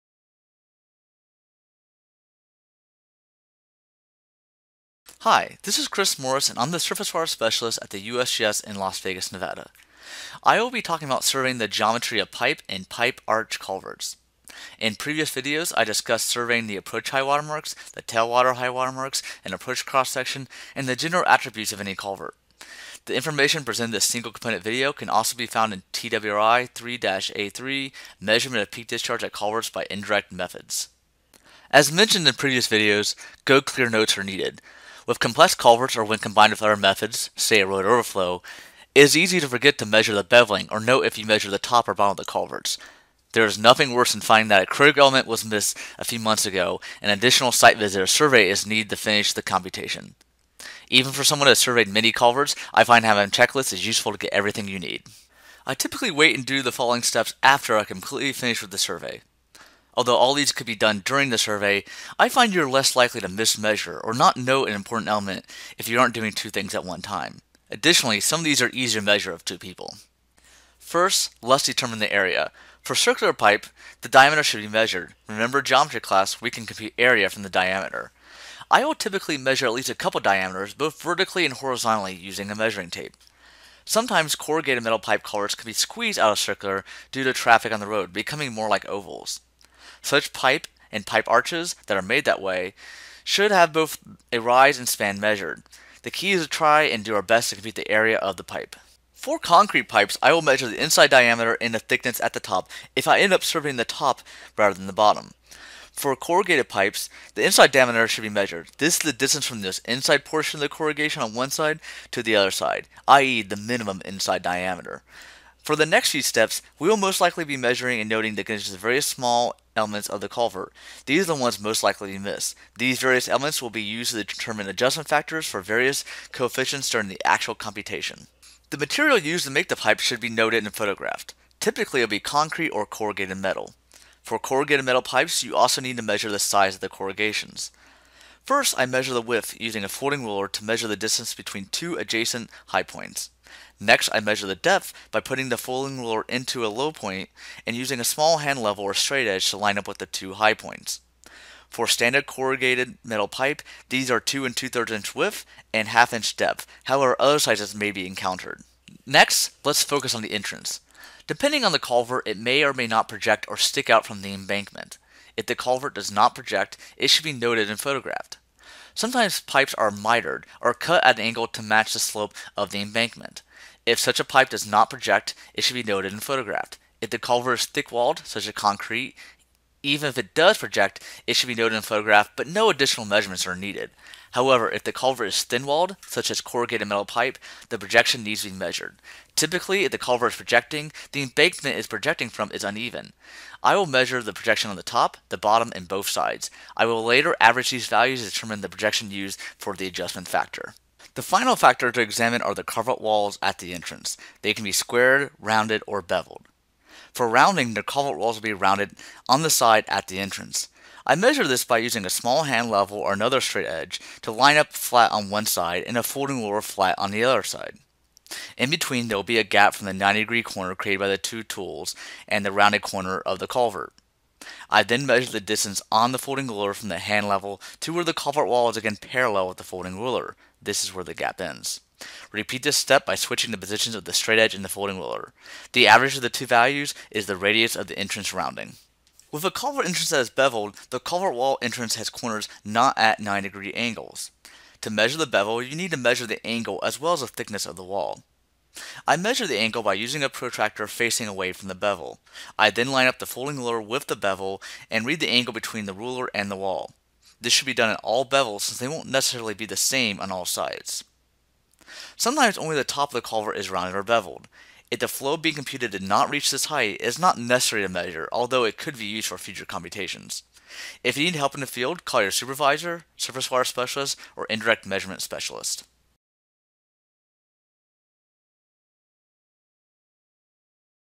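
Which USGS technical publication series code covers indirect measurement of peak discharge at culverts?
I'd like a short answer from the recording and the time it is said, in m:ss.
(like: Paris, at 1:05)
TWRI 3-A3, at 0:25.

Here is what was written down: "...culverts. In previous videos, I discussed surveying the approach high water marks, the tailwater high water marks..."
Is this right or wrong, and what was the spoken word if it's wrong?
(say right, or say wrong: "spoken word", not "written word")
right.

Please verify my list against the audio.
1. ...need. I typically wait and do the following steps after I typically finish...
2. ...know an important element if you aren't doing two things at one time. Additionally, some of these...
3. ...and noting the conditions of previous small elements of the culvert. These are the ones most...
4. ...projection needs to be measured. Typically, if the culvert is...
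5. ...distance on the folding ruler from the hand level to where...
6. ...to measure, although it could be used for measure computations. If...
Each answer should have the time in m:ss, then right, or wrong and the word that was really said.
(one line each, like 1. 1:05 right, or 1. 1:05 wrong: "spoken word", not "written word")
1. 0:54 wrong: "completely", not "typically"
2. 1:04 right
3. 1:57 wrong: "various", not "previous"
4. 3:07 right
5. 3:45 right
6. 4:27 wrong: "future", not "measure".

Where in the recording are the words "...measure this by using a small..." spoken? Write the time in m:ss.
3:31.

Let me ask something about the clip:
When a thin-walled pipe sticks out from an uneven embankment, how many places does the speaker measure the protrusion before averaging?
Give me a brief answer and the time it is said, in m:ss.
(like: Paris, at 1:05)
4, at 3:14.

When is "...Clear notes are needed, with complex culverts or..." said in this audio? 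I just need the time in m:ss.
0:33.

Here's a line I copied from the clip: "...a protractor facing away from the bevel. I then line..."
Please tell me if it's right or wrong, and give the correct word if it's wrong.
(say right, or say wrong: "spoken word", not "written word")
right.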